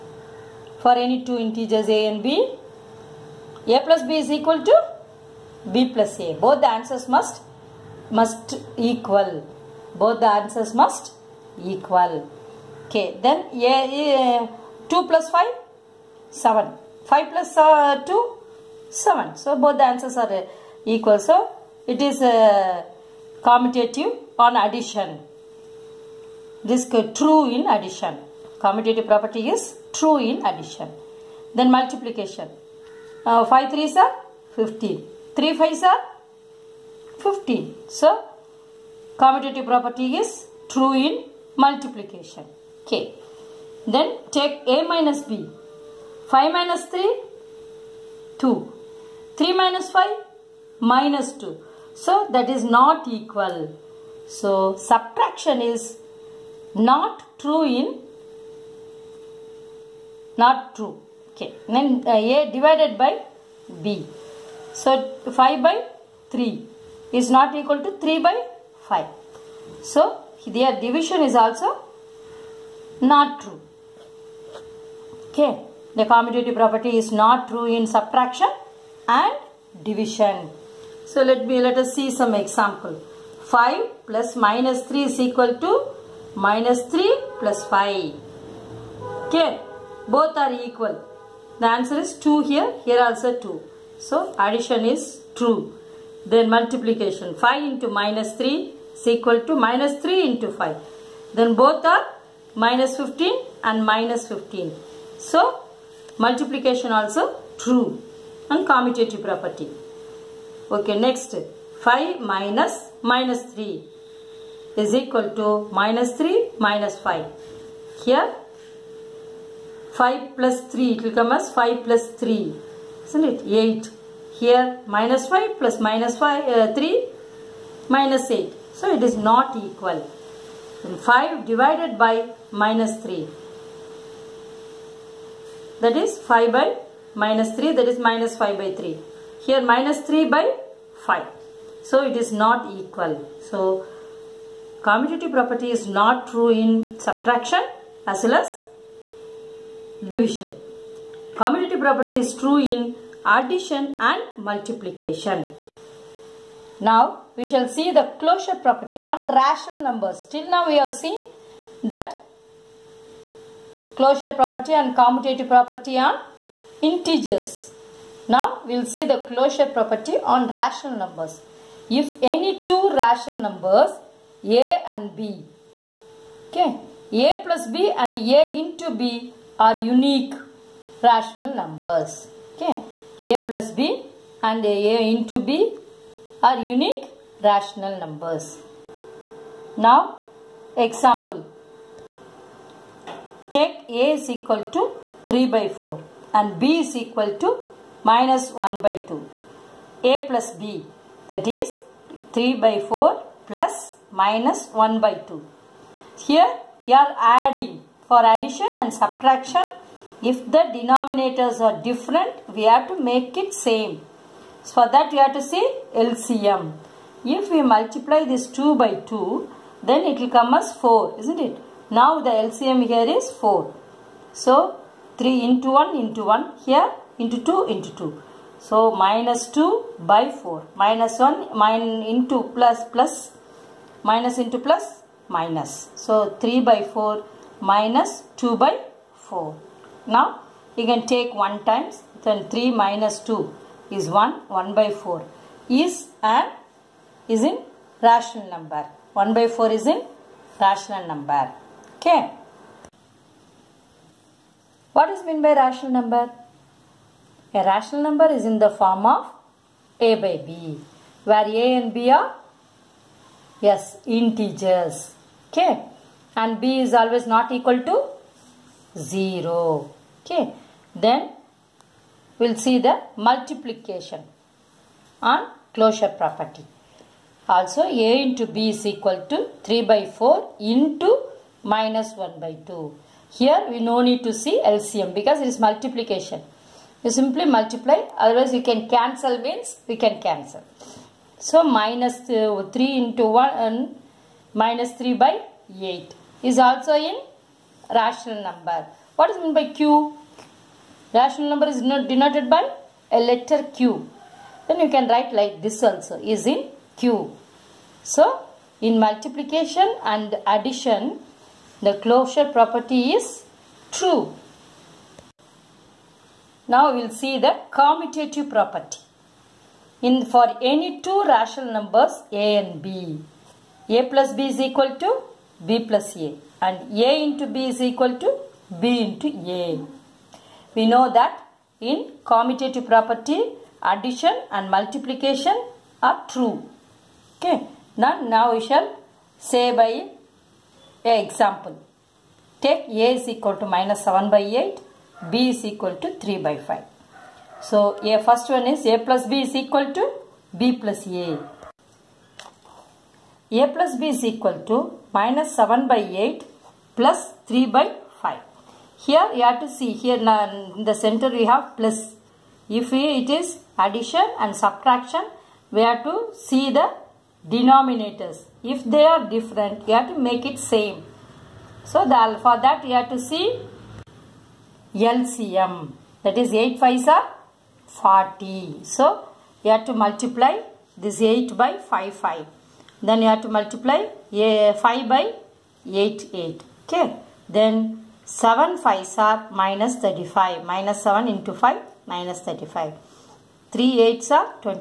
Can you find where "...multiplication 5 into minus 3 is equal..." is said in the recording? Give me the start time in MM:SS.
01:36.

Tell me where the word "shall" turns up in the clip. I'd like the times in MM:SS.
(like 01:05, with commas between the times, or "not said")
02:37, 05:38.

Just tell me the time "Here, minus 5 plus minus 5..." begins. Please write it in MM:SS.
02:04.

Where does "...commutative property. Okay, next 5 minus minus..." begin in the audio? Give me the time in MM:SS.
01:48.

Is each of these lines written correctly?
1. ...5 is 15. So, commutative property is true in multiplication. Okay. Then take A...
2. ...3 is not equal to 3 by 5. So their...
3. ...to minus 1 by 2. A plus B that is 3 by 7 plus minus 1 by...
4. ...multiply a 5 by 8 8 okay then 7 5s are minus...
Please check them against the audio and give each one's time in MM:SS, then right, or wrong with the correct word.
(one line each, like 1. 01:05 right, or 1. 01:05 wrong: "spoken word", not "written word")
1. 00:35 right
2. 01:06 right
3. 03:17 wrong: "4", not "7"
4. 06:23 right.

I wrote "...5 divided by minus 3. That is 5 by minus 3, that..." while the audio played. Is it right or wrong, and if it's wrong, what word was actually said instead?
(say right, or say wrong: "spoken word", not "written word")
right.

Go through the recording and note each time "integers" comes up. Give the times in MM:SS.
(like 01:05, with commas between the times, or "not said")
00:01, 02:46, 04:24.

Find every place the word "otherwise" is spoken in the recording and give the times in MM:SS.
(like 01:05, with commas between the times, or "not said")
04:48.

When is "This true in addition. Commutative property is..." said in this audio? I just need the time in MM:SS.
00:26.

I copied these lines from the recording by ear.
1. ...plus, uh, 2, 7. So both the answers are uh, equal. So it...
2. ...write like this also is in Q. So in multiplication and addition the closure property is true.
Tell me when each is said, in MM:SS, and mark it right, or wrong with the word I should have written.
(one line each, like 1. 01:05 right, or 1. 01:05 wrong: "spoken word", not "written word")
1. 00:17 right
2. 05:05 right.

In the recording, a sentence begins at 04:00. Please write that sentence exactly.
Now you can take 1 times then 3 minus 2 is 1 1 by 4 is an is in rational number.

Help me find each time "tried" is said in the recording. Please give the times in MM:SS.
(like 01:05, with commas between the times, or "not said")
not said.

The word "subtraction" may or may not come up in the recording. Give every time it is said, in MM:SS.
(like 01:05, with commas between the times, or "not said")
00:54, 01:17, 02:26, 03:29, 06:04.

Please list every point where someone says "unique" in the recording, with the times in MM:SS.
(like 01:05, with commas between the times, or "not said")
02:59, 03:06.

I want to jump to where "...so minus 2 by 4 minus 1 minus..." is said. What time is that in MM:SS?
03:48.